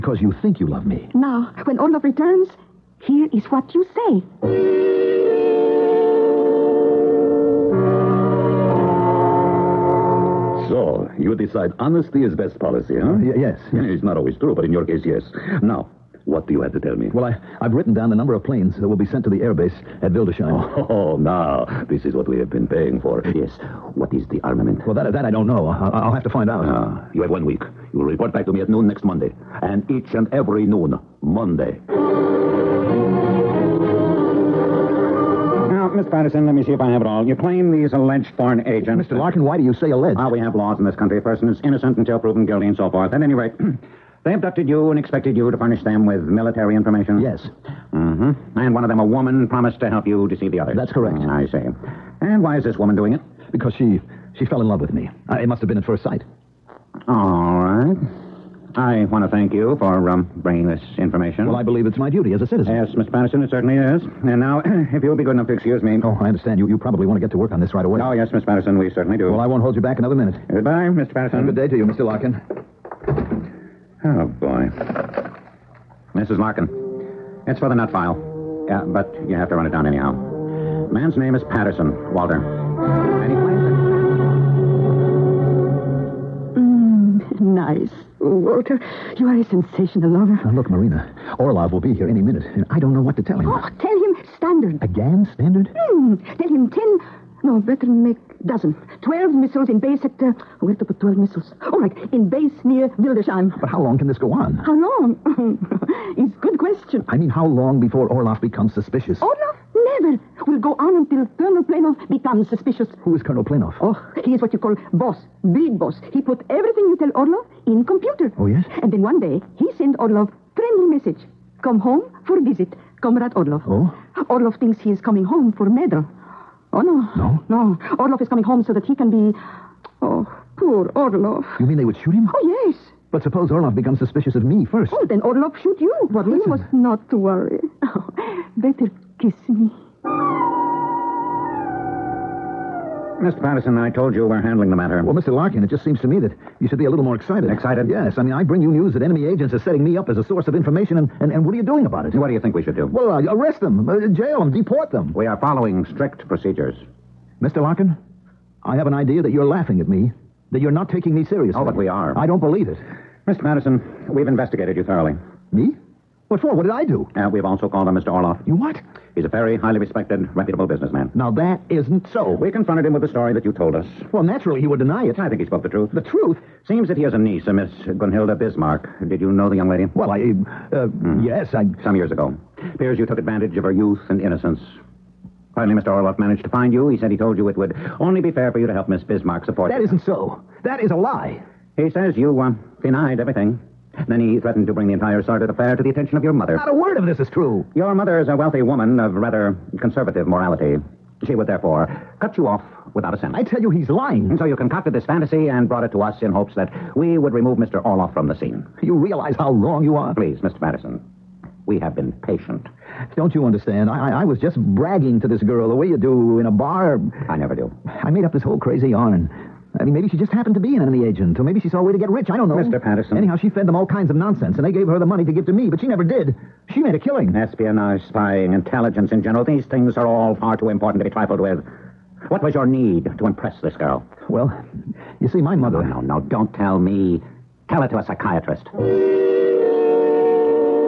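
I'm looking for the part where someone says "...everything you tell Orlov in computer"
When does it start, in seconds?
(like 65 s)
116 s.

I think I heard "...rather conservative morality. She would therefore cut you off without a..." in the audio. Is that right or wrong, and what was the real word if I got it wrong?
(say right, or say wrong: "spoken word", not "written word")
right.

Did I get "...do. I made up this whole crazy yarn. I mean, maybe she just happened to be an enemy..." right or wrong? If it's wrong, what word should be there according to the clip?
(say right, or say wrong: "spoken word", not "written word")
right.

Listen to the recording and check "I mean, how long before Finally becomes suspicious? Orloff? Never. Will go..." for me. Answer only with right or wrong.
wrong.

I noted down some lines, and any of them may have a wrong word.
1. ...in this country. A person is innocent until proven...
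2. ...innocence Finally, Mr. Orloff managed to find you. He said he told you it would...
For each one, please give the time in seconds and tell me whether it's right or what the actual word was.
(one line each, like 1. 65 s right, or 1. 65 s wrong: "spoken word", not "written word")
1. 40 s right
2. 184 s right.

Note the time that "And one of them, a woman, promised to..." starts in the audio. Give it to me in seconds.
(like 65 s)
48 s.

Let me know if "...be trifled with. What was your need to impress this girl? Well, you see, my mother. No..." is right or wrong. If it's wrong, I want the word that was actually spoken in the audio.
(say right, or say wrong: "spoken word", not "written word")
right.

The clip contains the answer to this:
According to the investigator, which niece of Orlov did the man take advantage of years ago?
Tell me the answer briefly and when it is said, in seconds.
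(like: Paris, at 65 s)
Gunhilda Bismarck, at 177 s.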